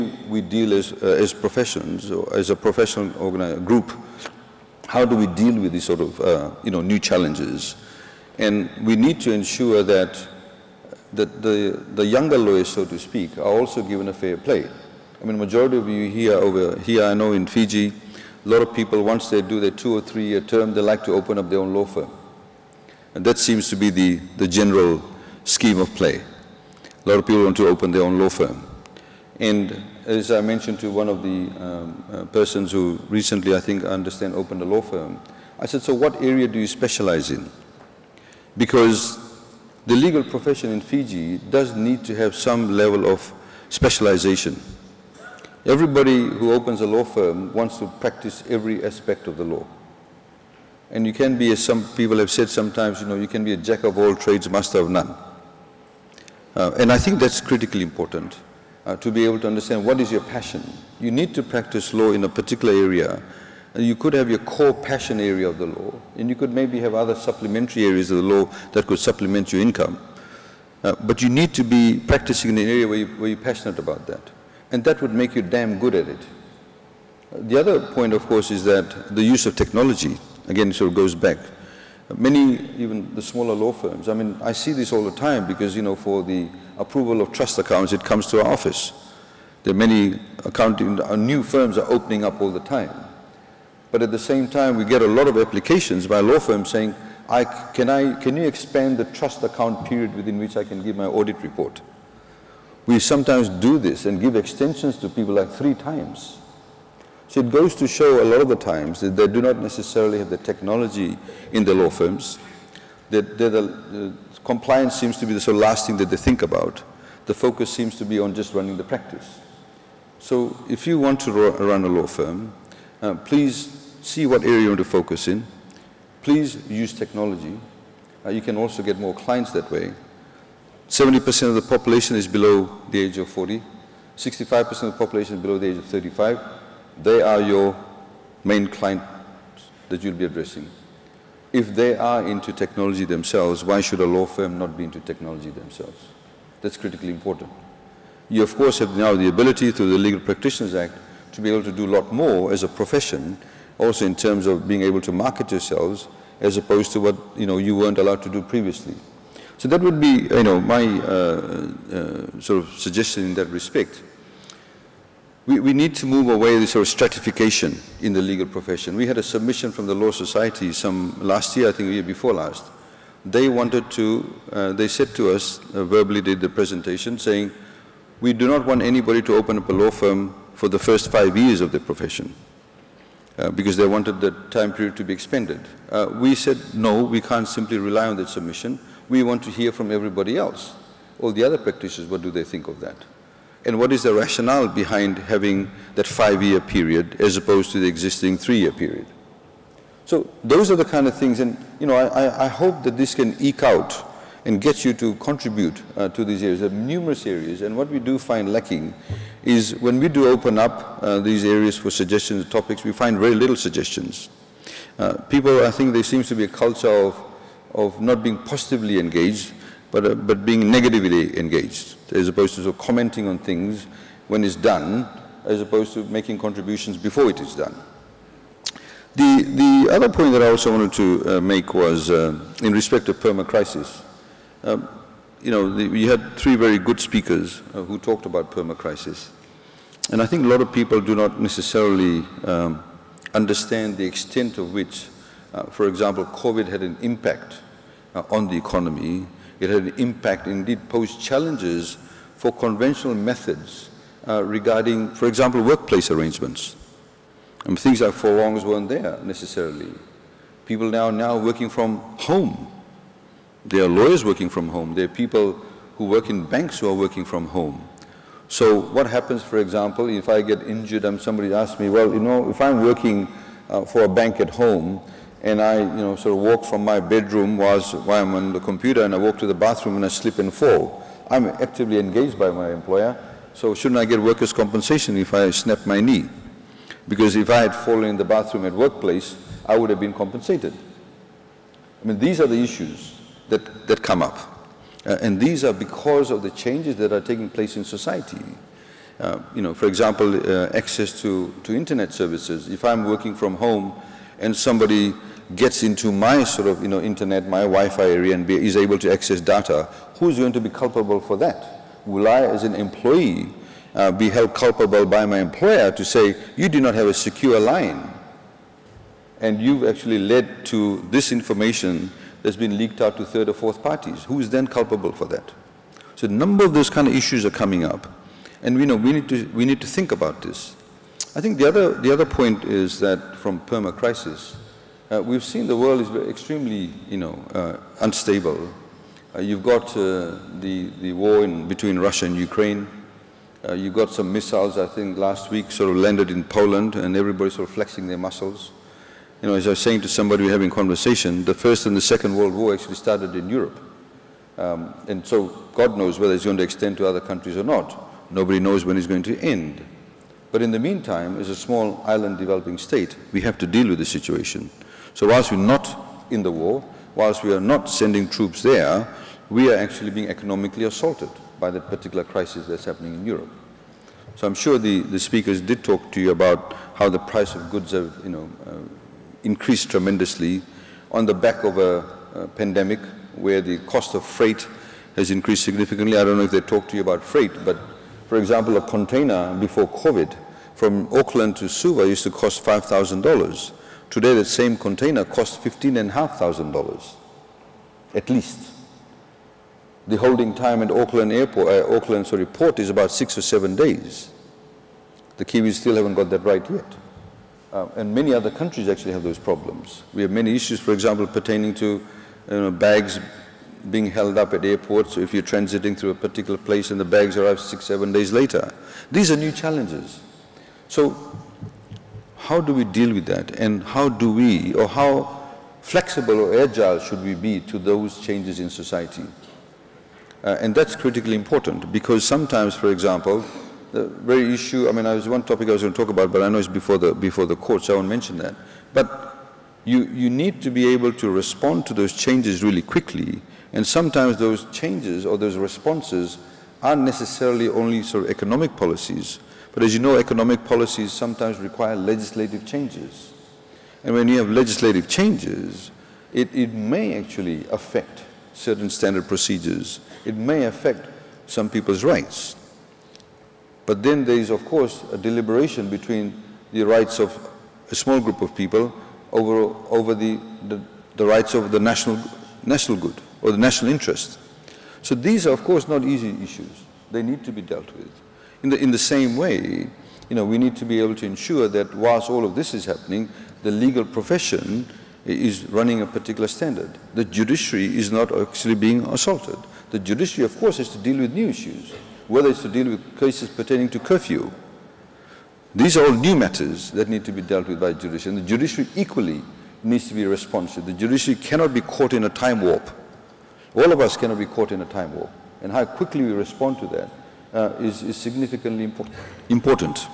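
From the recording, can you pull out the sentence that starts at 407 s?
Uh, and many other countries actually have those problems.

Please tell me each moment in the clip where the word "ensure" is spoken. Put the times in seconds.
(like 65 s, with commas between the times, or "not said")
9 s, 481 s.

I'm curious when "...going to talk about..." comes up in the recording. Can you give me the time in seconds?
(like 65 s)
435 s.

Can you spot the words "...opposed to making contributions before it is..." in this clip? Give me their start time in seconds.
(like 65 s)
225 s.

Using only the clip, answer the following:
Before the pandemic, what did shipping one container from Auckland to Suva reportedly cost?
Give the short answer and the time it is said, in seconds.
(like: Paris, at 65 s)
$5,000, at 392 s.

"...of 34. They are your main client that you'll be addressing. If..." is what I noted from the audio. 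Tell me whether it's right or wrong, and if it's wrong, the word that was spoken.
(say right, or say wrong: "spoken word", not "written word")
wrong: "35", not "34".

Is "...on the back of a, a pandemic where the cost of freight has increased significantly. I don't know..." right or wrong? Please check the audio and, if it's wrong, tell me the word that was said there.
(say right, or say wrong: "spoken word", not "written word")
right.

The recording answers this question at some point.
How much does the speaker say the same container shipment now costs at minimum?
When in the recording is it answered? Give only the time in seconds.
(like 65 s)
395 s.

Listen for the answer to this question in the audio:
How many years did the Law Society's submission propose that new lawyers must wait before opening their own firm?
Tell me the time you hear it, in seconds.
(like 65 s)
181 s.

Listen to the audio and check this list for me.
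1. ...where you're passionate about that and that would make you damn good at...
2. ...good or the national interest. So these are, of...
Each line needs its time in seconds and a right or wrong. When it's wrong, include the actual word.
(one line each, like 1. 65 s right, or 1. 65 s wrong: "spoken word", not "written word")
1. 73 s right
2. 472 s right.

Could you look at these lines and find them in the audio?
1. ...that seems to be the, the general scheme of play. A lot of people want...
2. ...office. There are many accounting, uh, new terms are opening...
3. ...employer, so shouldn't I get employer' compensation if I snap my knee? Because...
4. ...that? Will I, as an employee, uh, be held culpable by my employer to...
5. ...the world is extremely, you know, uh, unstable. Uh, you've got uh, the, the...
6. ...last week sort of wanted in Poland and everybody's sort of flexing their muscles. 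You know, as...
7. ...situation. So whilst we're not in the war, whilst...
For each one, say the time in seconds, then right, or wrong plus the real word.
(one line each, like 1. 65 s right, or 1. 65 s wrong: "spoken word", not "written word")
1. 23 s right
2. 88 s wrong: "firms", not "terms"
3. 282 s wrong: "workers", not "employer"
4. 311 s right
5. 335 s right
6. 345 s wrong: "landed", not "wanted"
7. 364 s right.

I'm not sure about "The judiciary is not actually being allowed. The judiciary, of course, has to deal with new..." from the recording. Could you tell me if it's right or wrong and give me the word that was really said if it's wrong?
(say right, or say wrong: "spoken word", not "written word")
wrong: "assaulted", not "allowed".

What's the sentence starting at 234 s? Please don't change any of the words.
Um, you know, the, we had three very good speakers uh, who talked about perma-crisis.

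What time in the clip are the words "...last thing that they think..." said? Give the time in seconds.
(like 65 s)
115 s.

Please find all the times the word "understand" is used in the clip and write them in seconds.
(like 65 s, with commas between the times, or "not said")
33 s, 59 s, 243 s.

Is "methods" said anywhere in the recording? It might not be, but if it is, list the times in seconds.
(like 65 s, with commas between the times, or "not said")
253 s.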